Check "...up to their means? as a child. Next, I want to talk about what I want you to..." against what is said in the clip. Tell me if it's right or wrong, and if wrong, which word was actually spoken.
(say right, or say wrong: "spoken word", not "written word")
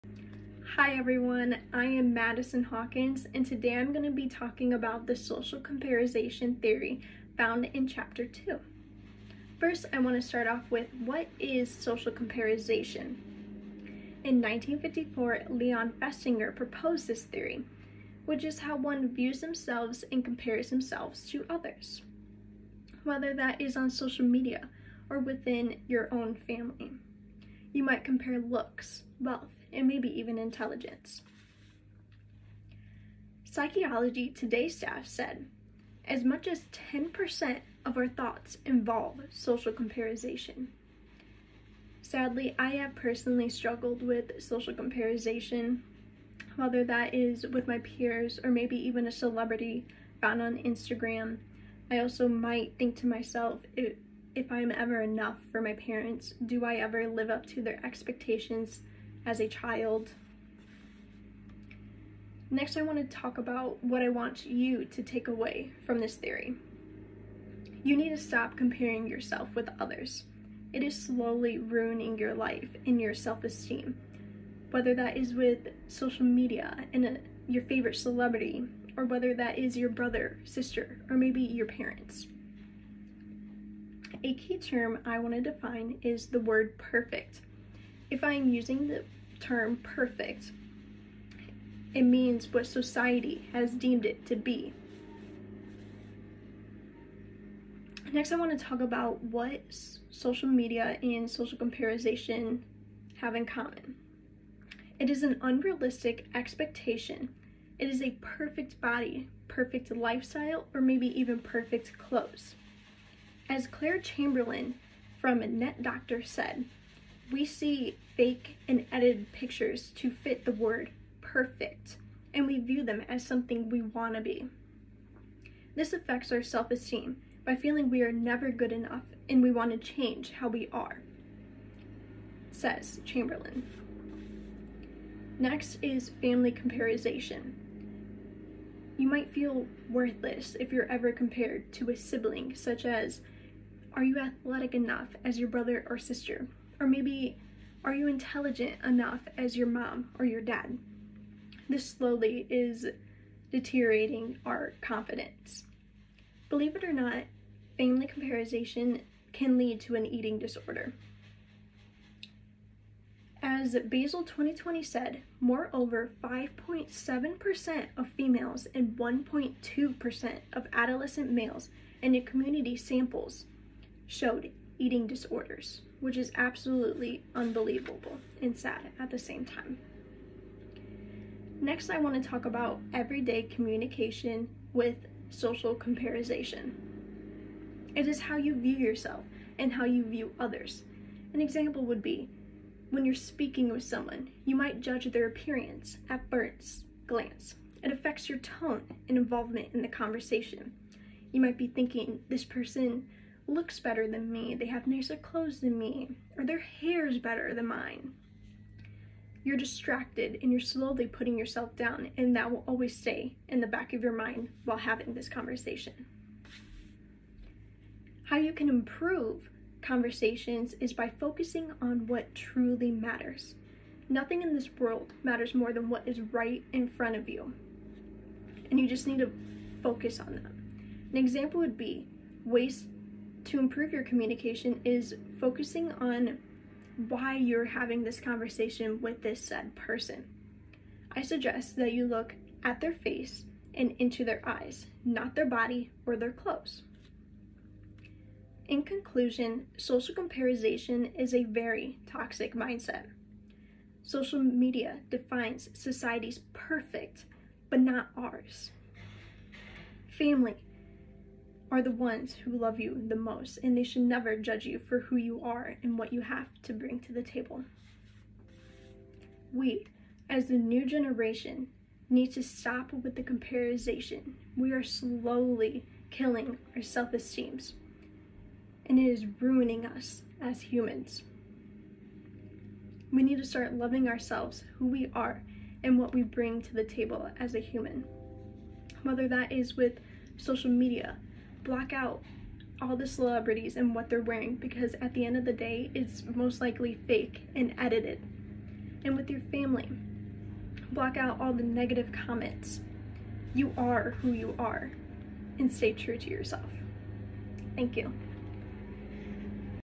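wrong: "expectations", not "means".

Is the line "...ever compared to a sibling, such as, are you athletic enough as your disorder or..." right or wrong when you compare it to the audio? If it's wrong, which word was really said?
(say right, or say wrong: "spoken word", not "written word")
wrong: "brother", not "disorder".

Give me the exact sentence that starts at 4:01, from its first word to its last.
I suggest that you look at their face and into their eyes, not their body or their clothes.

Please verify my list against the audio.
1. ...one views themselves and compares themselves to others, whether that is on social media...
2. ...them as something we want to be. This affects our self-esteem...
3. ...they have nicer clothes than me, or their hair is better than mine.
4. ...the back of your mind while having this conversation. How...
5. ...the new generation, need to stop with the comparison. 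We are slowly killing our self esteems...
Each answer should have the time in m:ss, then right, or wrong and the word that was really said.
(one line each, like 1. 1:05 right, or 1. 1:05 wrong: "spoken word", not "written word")
1. 0:18 right
2. 2:02 right
3. 3:24 right
4. 3:33 right
5. 4:30 right.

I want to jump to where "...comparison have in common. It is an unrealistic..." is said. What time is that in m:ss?
1:41.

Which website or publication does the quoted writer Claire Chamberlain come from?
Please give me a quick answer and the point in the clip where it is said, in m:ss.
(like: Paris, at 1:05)
Net Doctor, at 1:55.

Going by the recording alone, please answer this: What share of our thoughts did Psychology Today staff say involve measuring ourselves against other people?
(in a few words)
10%.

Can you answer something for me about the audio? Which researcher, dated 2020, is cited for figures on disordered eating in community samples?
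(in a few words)
Basil.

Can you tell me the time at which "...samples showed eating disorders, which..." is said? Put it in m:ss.
2:52.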